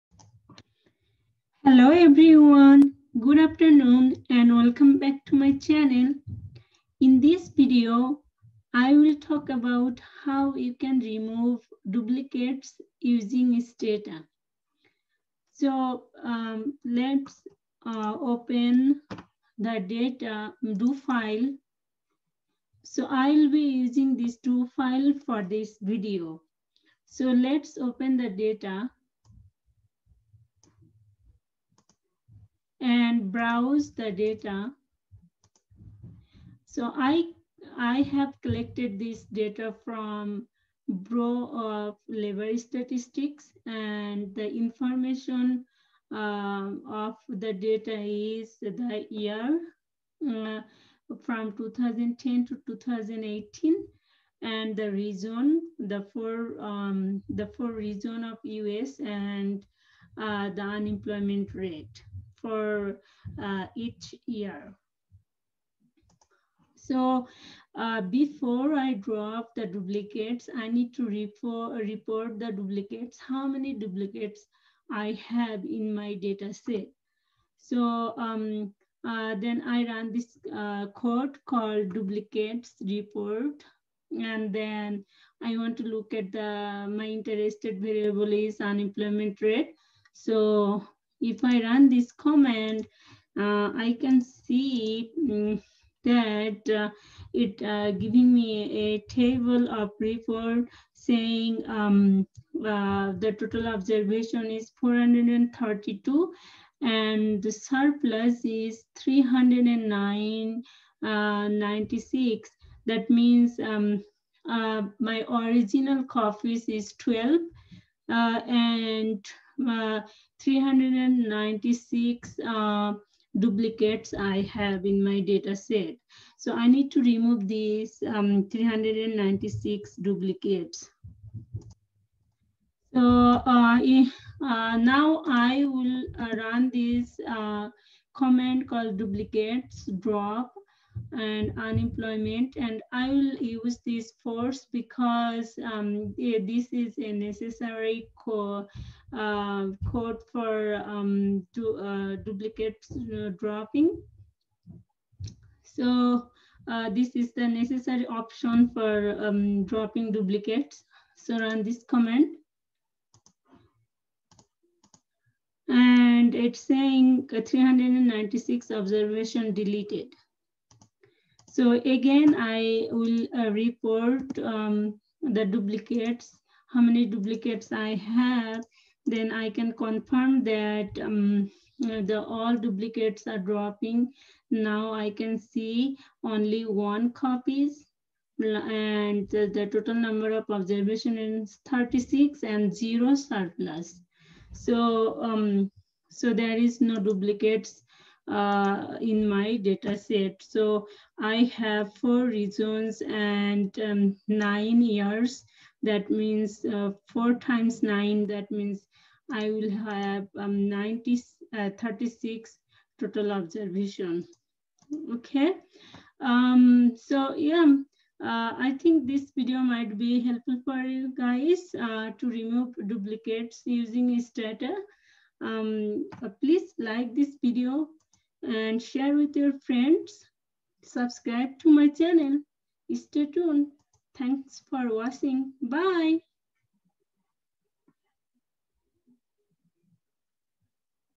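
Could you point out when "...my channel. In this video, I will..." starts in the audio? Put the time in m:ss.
0:05.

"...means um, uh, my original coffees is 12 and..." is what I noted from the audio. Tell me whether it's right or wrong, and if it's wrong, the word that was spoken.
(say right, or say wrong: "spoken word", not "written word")
right.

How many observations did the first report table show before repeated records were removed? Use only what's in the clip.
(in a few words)
432.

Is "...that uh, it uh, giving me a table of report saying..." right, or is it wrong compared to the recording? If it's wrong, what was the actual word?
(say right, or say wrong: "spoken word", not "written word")
right.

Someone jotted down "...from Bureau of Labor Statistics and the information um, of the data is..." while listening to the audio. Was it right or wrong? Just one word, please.
right.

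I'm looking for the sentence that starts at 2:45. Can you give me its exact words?
And it's saying 396 observation deleted.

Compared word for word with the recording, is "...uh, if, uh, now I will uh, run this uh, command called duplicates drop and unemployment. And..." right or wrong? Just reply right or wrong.
right.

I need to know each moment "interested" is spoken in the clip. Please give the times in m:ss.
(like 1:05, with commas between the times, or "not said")
1:27.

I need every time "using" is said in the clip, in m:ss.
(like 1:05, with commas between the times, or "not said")
0:12, 0:23, 3:43.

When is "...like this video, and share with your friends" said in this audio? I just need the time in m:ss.
3:46.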